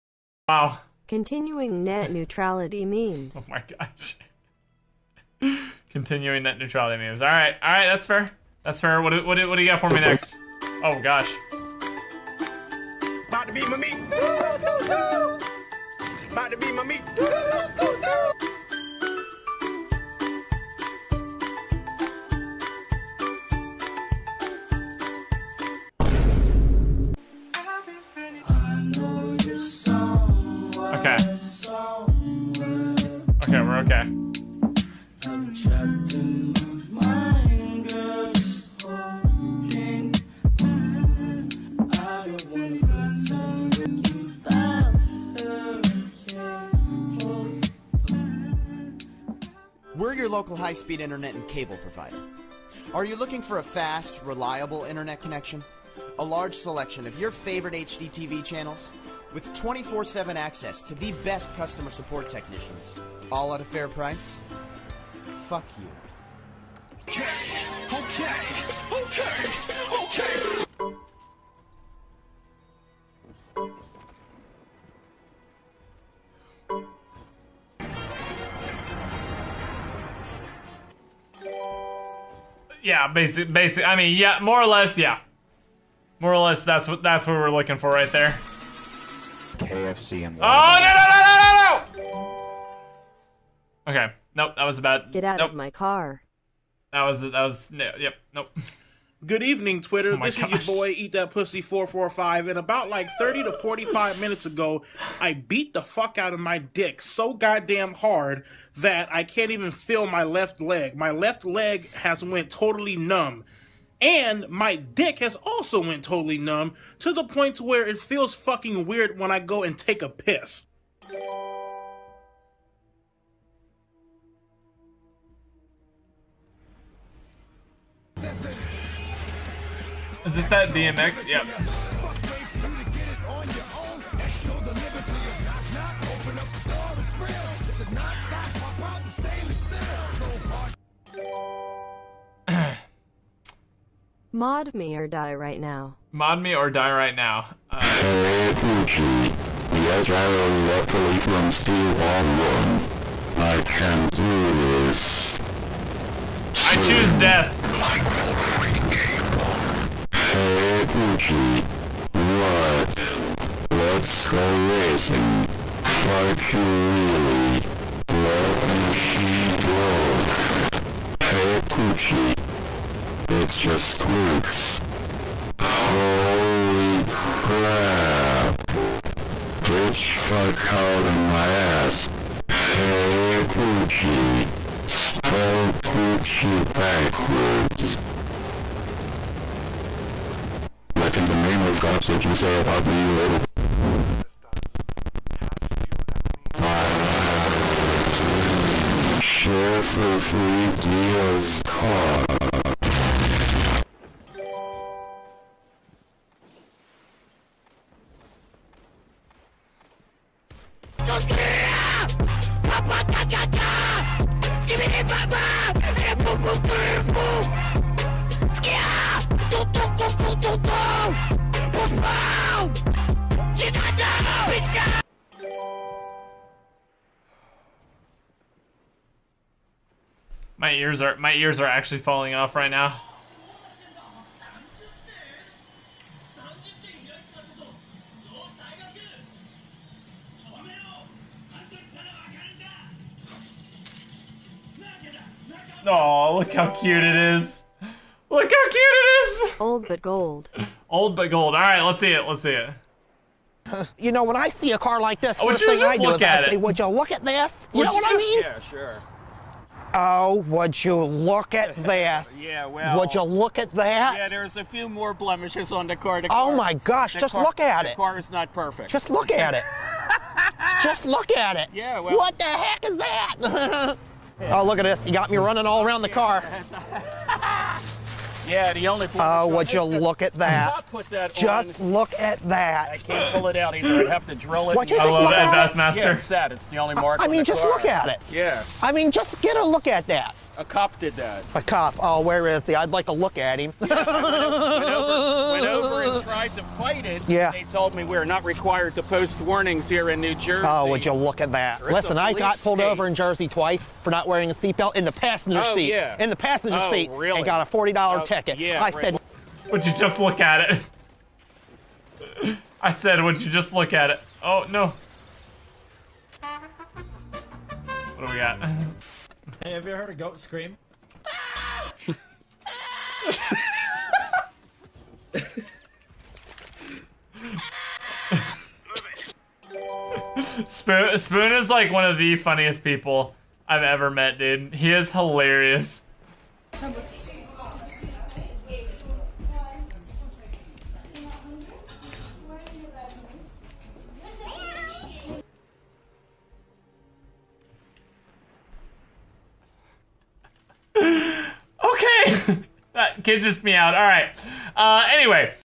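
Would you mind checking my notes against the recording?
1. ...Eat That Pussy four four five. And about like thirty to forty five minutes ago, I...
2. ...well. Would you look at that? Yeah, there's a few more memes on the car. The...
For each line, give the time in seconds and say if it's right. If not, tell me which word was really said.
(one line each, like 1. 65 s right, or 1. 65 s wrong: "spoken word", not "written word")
1. 100 s right
2. 262 s wrong: "blemishes", not "memes".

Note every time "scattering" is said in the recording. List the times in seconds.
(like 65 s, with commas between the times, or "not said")
not said.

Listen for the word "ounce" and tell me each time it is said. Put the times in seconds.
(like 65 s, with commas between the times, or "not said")
not said.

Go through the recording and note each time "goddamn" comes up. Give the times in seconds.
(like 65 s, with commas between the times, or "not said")
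107 s.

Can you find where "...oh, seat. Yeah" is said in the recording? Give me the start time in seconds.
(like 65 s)
305 s.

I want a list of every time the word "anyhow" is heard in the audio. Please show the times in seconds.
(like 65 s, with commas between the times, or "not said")
not said.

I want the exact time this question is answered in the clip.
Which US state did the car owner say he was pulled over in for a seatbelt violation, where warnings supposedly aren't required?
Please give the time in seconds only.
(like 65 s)
300 s.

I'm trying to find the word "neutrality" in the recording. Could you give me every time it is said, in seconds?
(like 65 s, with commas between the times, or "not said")
2 s, 6 s.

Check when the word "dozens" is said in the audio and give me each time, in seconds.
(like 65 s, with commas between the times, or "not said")
not said.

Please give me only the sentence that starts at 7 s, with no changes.
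All right, all right, that's fair.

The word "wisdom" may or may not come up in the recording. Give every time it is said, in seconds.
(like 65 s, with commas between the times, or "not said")
not said.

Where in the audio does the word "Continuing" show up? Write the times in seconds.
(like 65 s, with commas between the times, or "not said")
1 s, 5 s.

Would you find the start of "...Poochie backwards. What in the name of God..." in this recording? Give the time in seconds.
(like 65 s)
185 s.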